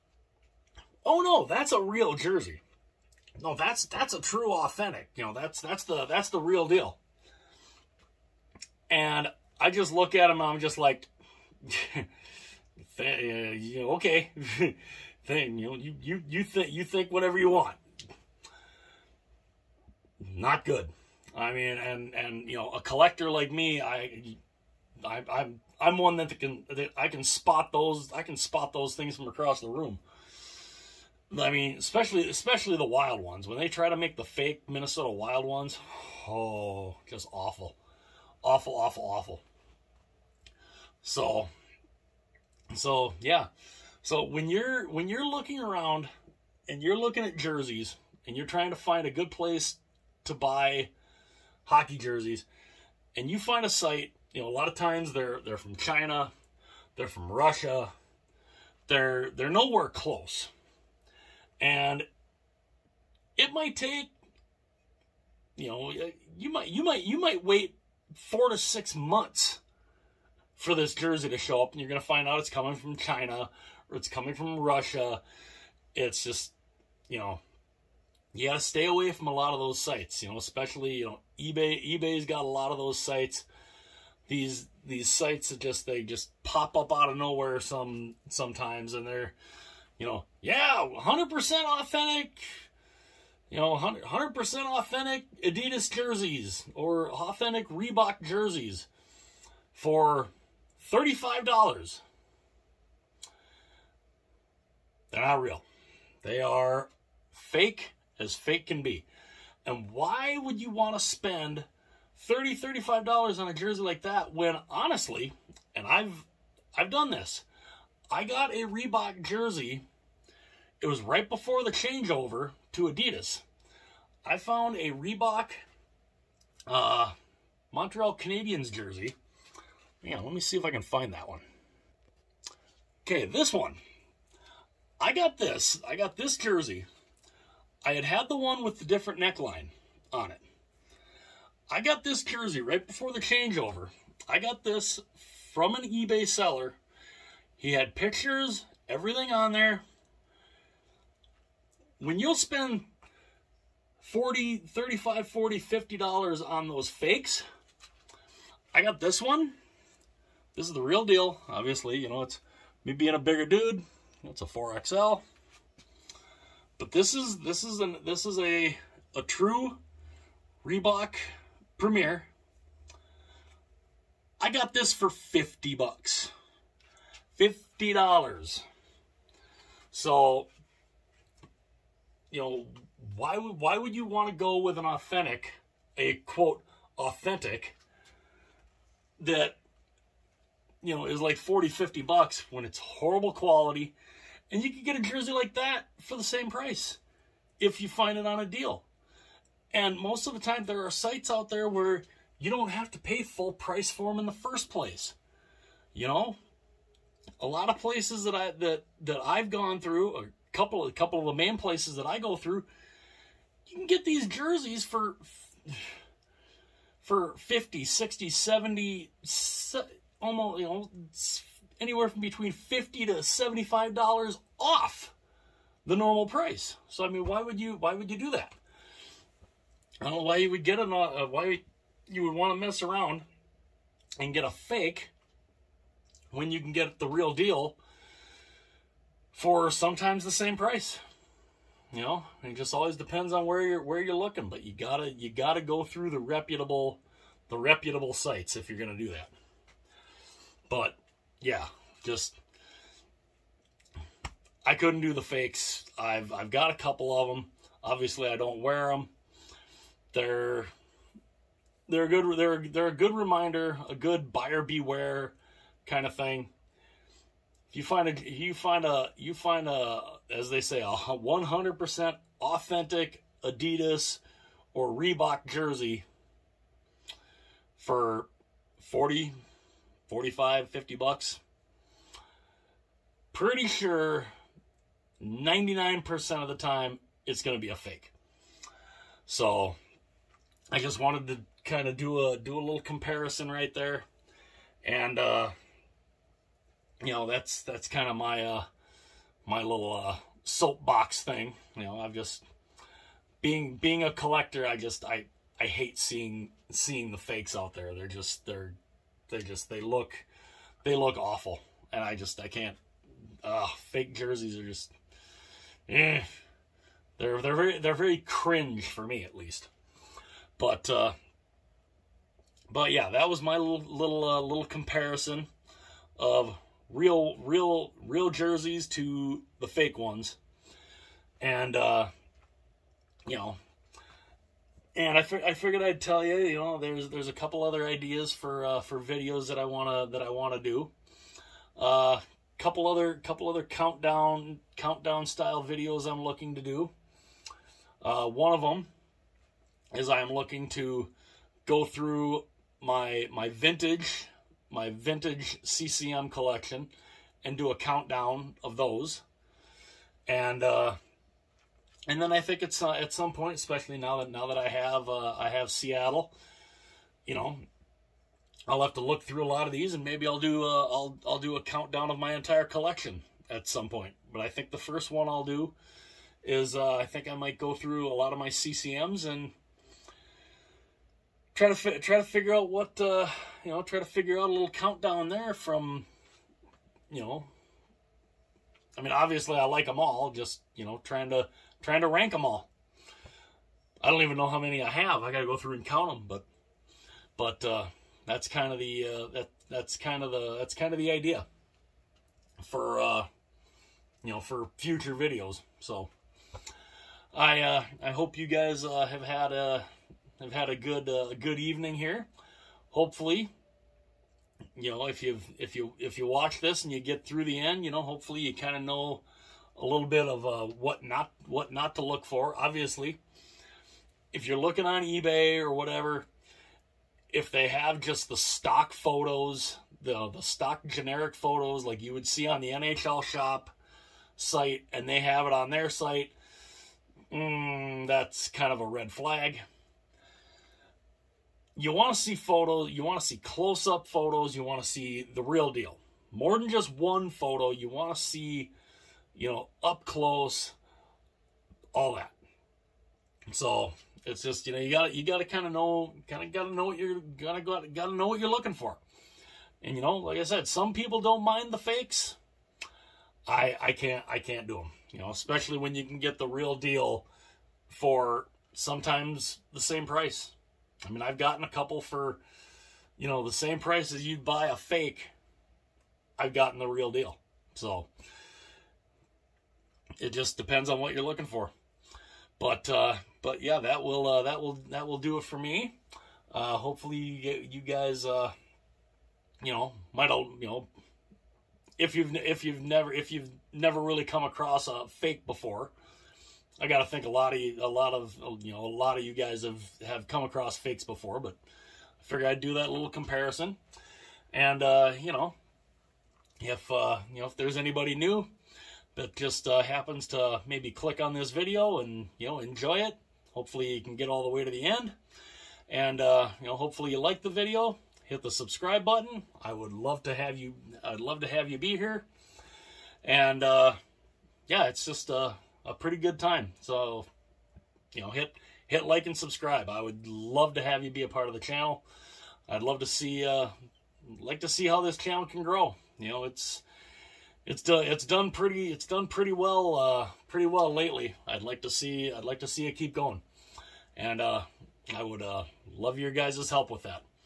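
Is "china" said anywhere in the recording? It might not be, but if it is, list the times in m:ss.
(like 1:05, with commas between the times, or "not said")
0:55, 1:12.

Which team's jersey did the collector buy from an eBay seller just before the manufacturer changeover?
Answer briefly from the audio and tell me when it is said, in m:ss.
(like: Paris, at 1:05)
Montreal Canadiens, at 2:07.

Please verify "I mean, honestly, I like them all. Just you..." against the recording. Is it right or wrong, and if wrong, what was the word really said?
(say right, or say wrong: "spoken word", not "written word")
wrong: "obviously", not "honestly".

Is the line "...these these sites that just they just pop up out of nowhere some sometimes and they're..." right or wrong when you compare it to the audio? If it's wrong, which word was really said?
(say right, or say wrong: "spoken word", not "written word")
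right.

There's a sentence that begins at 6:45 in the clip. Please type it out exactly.
So I uh, I hope you guys uh, have had a uh, have had a good uh, good evening here.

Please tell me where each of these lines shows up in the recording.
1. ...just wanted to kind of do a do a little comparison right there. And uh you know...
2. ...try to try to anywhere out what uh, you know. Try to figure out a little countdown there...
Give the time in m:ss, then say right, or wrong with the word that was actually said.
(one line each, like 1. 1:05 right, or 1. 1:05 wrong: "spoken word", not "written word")
1. 4:50 right
2. 6:21 wrong: "figure", not "anywhere".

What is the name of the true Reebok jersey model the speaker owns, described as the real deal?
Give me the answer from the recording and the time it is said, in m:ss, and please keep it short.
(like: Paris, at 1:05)
Reebok Premiere, at 2:50.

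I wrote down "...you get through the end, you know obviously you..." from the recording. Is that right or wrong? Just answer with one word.
wrong.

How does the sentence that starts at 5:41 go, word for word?
Uh, couple other, couple other countdown, countdown style videos I'm looking to do.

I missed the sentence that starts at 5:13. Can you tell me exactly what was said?
Uh, fake jerseys are just, eh.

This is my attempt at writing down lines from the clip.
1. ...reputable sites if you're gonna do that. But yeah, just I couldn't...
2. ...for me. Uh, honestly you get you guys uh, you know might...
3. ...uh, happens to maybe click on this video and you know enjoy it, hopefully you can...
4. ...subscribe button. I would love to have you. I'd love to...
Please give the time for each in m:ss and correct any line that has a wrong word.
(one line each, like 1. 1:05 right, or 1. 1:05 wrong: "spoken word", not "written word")
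1. 4:07 right
2. 8:05 wrong: "hopefully", not "honestly"
3. 8:29 right
4. 8:38 right.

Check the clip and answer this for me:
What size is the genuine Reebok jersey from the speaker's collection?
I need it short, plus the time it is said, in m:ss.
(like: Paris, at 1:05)
4XL, at 2:44.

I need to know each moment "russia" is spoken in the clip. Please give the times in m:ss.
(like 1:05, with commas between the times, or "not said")
0:57, 1:14.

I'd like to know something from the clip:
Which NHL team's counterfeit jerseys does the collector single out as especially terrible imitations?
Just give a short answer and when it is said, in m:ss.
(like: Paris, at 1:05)
Minnesota Wild, at 0:34.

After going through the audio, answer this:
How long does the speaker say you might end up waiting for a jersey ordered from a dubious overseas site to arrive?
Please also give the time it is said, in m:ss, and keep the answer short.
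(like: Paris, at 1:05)
4 to 6 months, at 1:08.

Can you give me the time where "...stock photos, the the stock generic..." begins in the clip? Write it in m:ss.
7:08.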